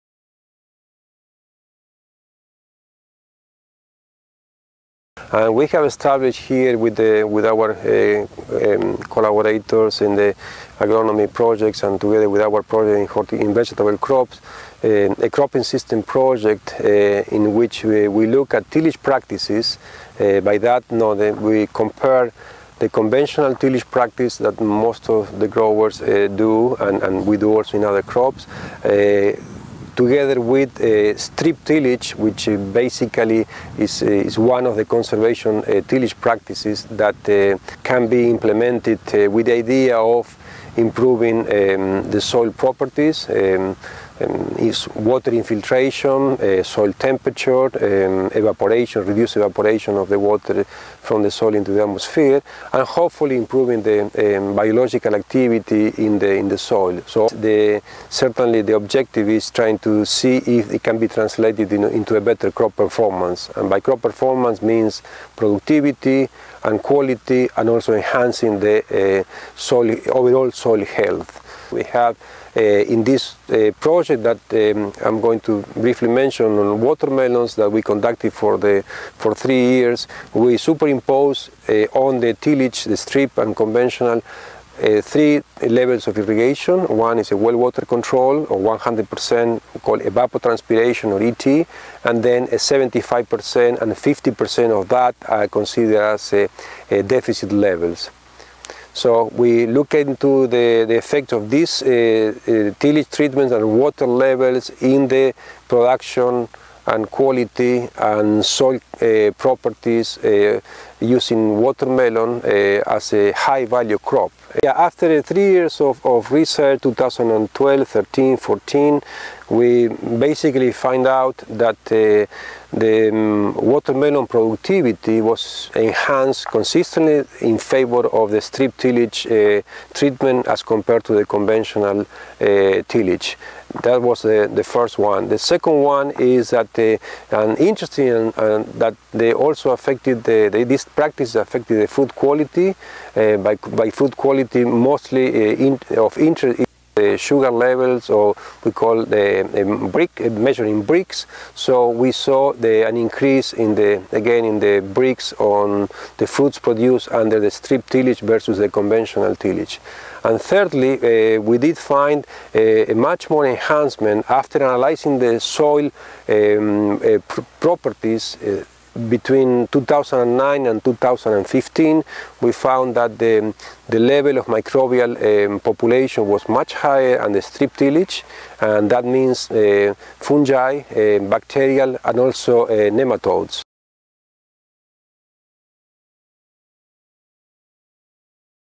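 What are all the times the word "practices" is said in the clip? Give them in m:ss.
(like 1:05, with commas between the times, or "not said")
0:19, 0:23, 0:36, 2:20.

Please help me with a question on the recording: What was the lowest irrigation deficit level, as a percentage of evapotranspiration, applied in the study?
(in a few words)
50%.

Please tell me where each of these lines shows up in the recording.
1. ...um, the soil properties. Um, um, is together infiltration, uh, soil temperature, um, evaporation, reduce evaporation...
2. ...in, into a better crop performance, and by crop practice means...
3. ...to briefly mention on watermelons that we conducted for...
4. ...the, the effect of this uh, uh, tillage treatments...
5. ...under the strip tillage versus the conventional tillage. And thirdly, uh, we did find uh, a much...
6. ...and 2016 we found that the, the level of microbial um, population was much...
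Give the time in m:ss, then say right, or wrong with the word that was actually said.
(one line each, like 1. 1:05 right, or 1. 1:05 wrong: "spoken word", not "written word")
1. 0:41 wrong: "water", not "together"
2. 1:01 wrong: "performance", not "practice"
3. 1:15 right
4. 1:40 right
5. 2:37 right
6. 2:50 wrong: "2015", not "2016".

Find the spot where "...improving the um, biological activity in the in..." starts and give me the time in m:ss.
0:53.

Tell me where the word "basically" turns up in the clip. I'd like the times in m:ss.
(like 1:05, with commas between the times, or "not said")
0:32, 1:59.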